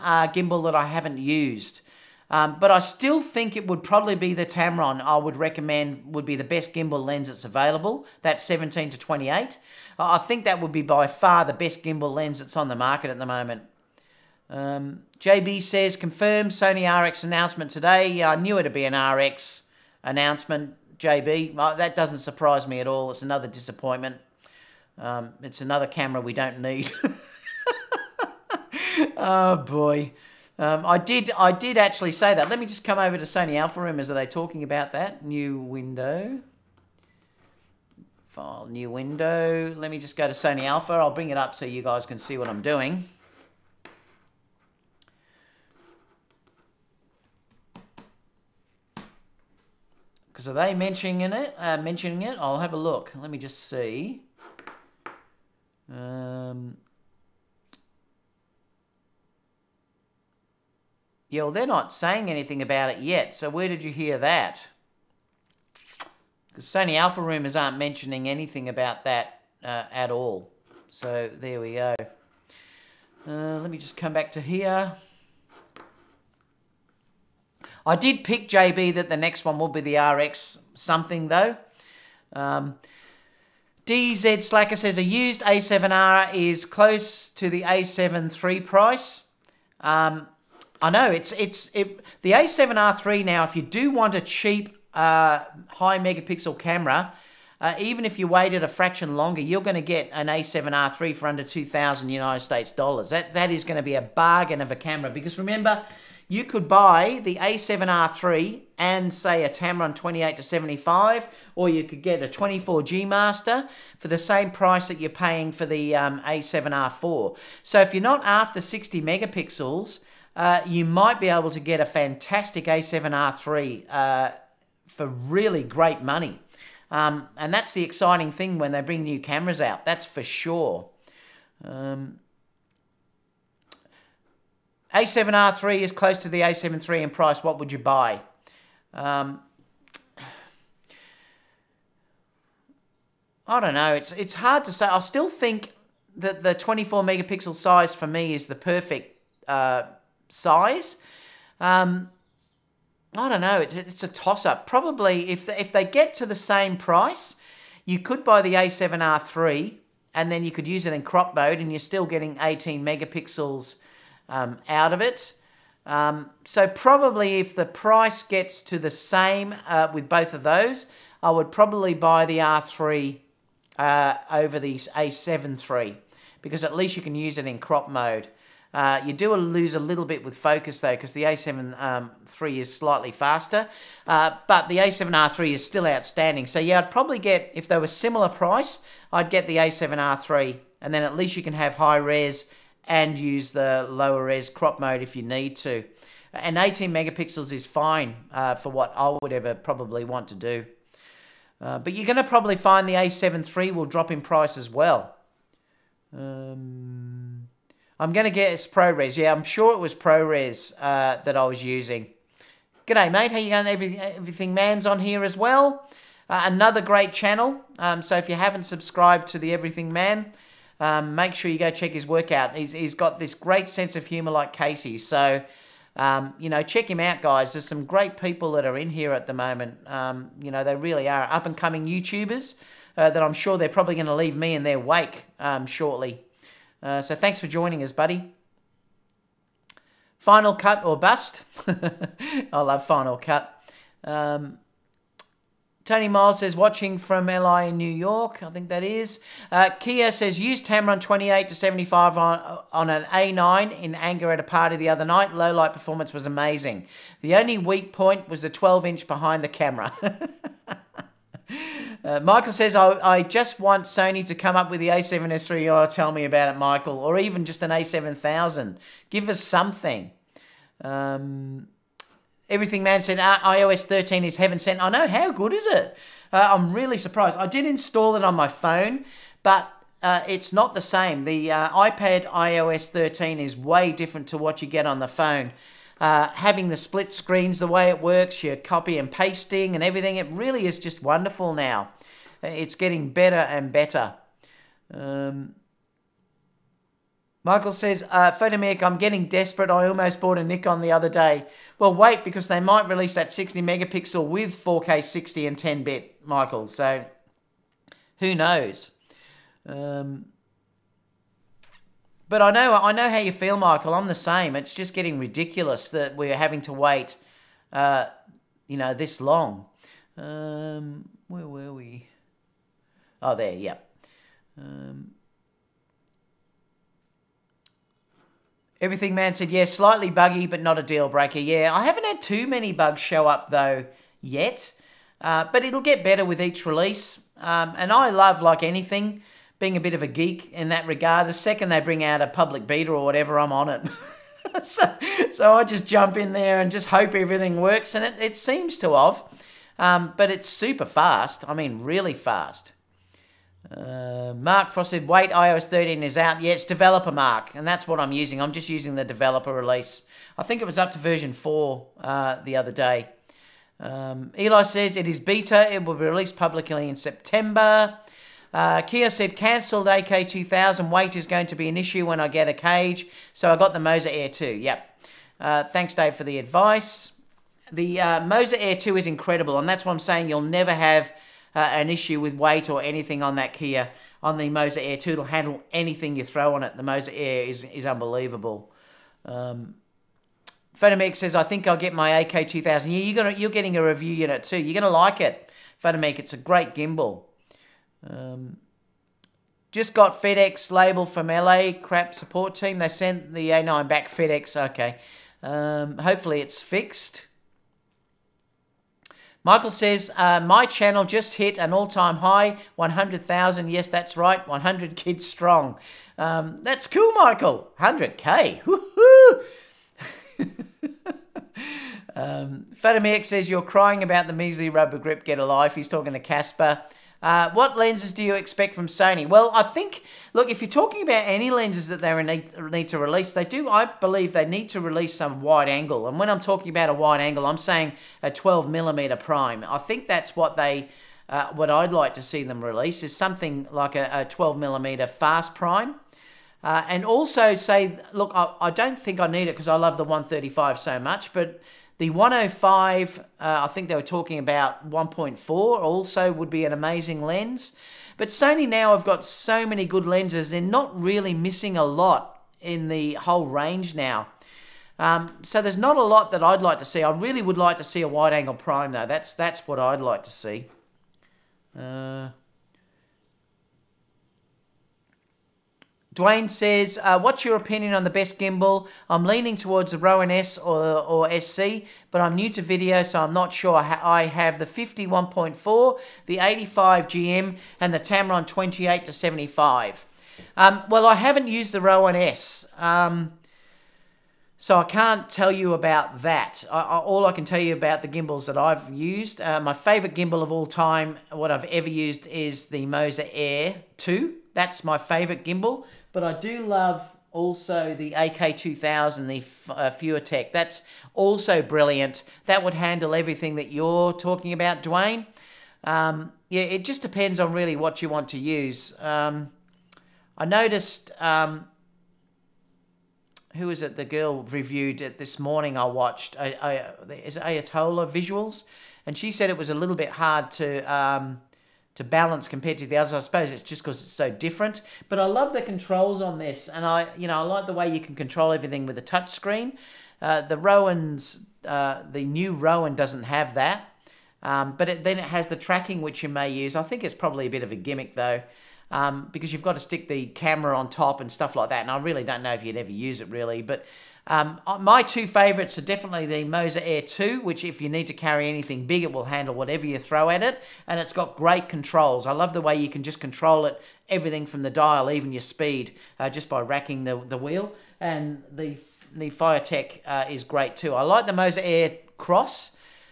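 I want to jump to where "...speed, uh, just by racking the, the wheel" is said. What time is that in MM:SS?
09:25.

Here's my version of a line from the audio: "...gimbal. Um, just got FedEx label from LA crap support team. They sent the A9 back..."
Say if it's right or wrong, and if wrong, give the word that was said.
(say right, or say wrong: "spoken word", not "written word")
right.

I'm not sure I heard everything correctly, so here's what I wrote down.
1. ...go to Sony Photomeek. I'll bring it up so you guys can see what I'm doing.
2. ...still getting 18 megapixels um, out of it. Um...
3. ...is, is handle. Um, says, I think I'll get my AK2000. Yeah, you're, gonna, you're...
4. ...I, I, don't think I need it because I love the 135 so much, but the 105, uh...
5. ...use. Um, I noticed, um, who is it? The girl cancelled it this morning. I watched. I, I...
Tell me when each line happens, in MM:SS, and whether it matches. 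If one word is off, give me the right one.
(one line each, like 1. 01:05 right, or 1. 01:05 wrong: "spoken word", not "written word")
1. 00:40 wrong: "Alpha", not "Photomeek"
2. 02:41 right
3. 06:27 wrong: "unbelievable", not "handle"
4. 07:28 right
5. 08:38 wrong: "reviewed", not "cancelled".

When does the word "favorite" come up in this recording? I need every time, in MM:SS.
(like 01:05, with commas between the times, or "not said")
08:19, 08:24, 09:15.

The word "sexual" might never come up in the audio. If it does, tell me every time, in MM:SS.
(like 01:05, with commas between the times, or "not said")
not said.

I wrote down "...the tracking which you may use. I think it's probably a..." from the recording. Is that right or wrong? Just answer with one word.
right.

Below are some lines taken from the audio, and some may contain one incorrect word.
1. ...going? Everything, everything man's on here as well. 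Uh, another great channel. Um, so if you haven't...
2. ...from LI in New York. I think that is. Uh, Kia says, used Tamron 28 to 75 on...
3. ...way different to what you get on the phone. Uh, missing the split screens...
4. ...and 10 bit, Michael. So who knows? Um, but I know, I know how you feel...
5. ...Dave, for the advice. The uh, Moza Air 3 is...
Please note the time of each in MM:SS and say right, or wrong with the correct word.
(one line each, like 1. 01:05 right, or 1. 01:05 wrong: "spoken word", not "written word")
1. 03:33 right
2. 04:06 right
3. 04:43 wrong: "having", not "missing"
4. 05:05 right
5. 06:15 wrong: "2", not "3".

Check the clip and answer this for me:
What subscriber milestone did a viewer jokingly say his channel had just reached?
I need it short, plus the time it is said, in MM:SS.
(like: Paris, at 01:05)
100,000, at 06:52.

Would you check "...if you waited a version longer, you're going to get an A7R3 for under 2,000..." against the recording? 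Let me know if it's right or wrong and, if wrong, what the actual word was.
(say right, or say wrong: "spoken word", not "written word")
wrong: "fraction", not "version".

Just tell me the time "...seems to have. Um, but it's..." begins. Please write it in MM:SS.
05:48.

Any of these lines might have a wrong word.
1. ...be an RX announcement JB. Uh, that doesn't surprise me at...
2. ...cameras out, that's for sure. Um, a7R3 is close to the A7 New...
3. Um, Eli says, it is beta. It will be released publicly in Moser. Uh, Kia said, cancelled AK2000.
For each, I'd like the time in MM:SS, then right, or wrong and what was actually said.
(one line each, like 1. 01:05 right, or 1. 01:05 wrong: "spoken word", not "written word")
1. 00:18 right
2. 02:09 wrong: "III", not "New"
3. 06:03 wrong: "September", not "Moser".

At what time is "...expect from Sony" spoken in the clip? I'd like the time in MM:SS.
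07:08.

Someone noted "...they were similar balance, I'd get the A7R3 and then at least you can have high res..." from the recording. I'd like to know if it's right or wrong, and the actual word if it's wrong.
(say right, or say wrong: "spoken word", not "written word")
wrong: "price", not "balance".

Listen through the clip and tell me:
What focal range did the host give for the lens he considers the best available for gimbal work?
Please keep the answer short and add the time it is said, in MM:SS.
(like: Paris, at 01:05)
17 to 28, at 00:08.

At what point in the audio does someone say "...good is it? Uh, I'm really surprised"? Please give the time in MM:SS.
04:35.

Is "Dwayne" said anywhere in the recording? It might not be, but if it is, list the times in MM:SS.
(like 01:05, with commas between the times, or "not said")
07:56, 08:34.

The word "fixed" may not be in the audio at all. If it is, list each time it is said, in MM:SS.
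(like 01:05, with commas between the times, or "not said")
06:46.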